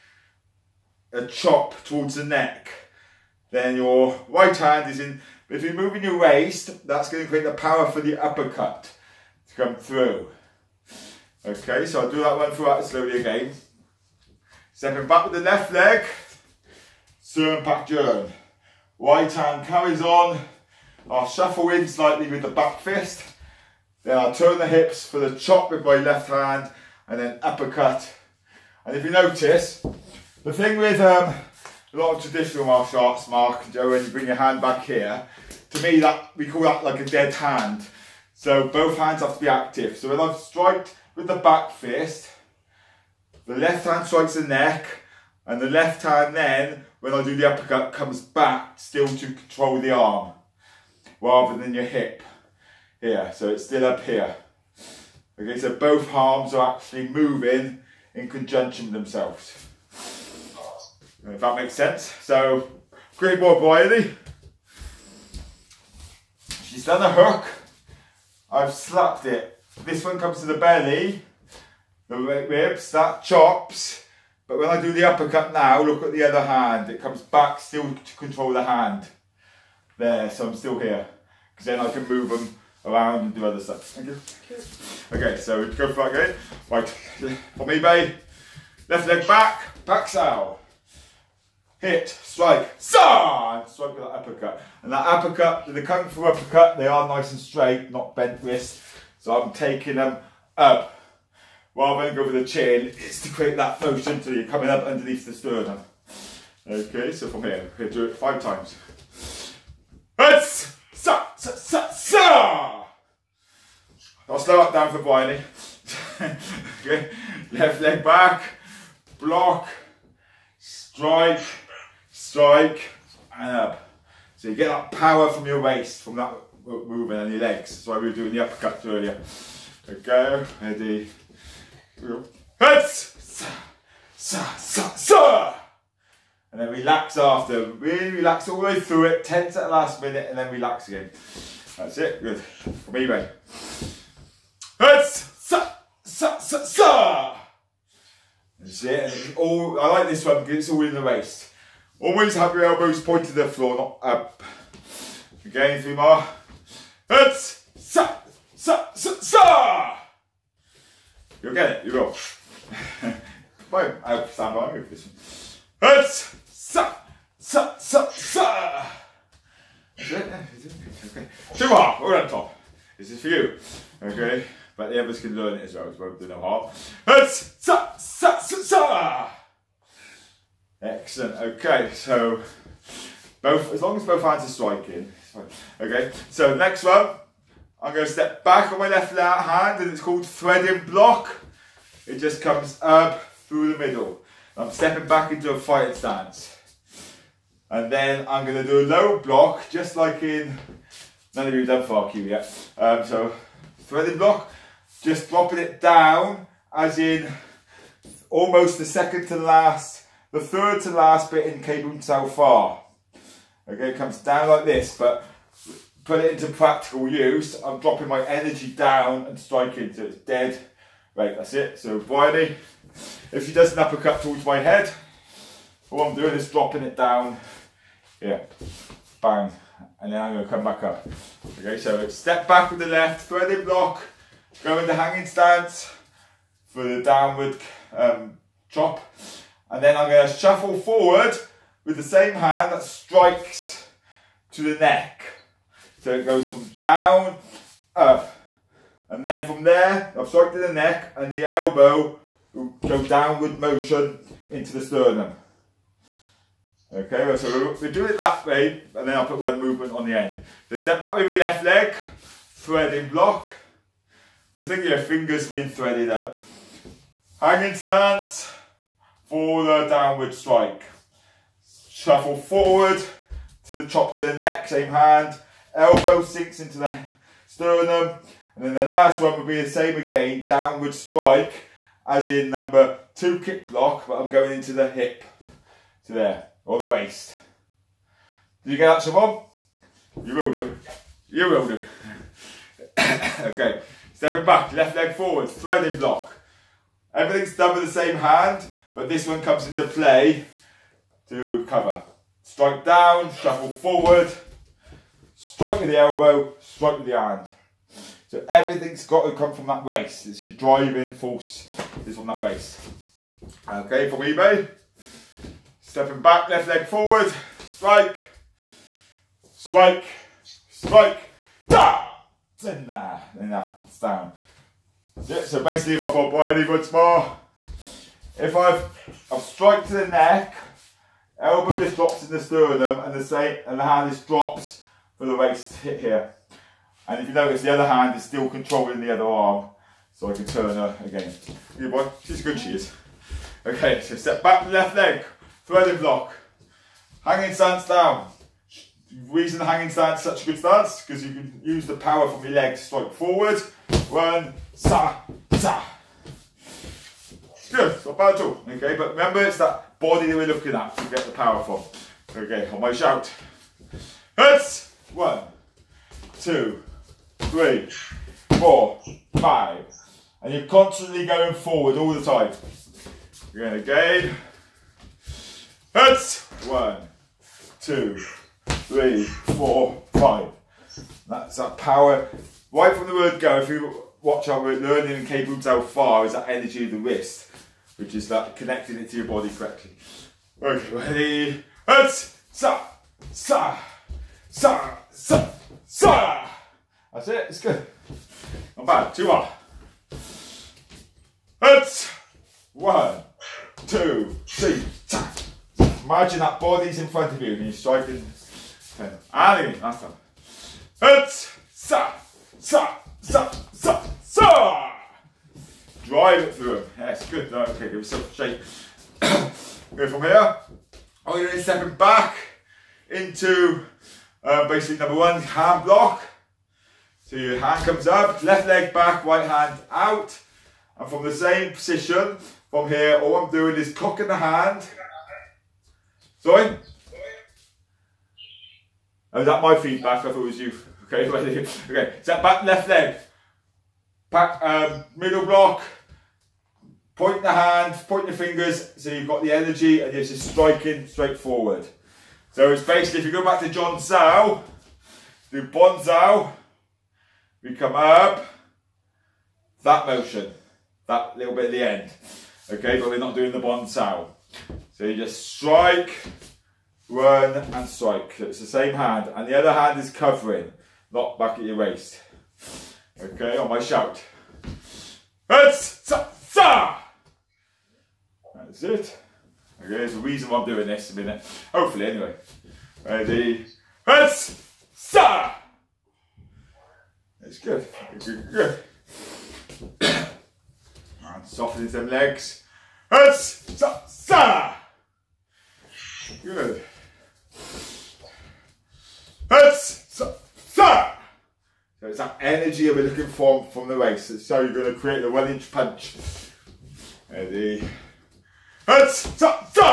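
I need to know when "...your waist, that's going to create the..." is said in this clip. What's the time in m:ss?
0:06.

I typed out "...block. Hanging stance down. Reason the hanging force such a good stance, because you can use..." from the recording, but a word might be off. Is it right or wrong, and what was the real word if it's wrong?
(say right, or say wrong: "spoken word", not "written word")
wrong: "stance", not "force".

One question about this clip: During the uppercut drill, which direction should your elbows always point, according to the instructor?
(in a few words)
floor.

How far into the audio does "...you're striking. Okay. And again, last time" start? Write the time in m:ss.
6:47.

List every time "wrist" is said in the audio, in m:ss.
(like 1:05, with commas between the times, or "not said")
1:38, 6:26.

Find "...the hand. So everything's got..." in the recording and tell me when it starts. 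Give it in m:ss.
5:07.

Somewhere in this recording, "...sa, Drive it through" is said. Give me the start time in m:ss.
6:54.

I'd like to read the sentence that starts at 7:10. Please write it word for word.
And from the same position, from here, all I'm doing is cocking the hand.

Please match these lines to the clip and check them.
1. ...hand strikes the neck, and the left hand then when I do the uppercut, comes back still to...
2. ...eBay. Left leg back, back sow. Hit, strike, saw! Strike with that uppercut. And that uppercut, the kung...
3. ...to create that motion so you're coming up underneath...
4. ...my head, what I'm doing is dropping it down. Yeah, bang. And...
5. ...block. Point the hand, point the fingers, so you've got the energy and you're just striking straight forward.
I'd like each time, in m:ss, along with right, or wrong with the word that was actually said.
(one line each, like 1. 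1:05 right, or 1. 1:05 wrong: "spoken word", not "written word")
1. 0:43 right
2. 1:27 right
3. 1:43 right
4. 3:44 right
5. 7:25 right.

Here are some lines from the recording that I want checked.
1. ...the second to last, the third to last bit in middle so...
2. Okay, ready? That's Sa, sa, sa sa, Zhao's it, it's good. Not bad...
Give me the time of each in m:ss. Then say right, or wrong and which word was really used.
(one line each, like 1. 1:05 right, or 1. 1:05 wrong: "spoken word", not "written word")
1. 3:28 wrong: "cable", not "middle"
2. 6:30 wrong: "That", not "Zhao".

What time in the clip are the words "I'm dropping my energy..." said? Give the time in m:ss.
3:37.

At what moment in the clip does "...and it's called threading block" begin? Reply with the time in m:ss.
3:09.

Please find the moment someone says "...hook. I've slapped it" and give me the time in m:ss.
1:07.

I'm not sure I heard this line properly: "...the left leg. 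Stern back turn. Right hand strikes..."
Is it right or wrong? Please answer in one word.
wrong.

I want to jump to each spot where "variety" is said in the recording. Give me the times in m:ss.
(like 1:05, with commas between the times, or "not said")
1:03.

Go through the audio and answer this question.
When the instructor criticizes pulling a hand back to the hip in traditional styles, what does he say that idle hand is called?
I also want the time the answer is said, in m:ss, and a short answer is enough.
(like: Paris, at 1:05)
dead hand, at 0:37.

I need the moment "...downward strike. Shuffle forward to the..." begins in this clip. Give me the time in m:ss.
4:29.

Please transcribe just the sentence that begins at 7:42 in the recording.
Okay, but we're not doing the Bonzao.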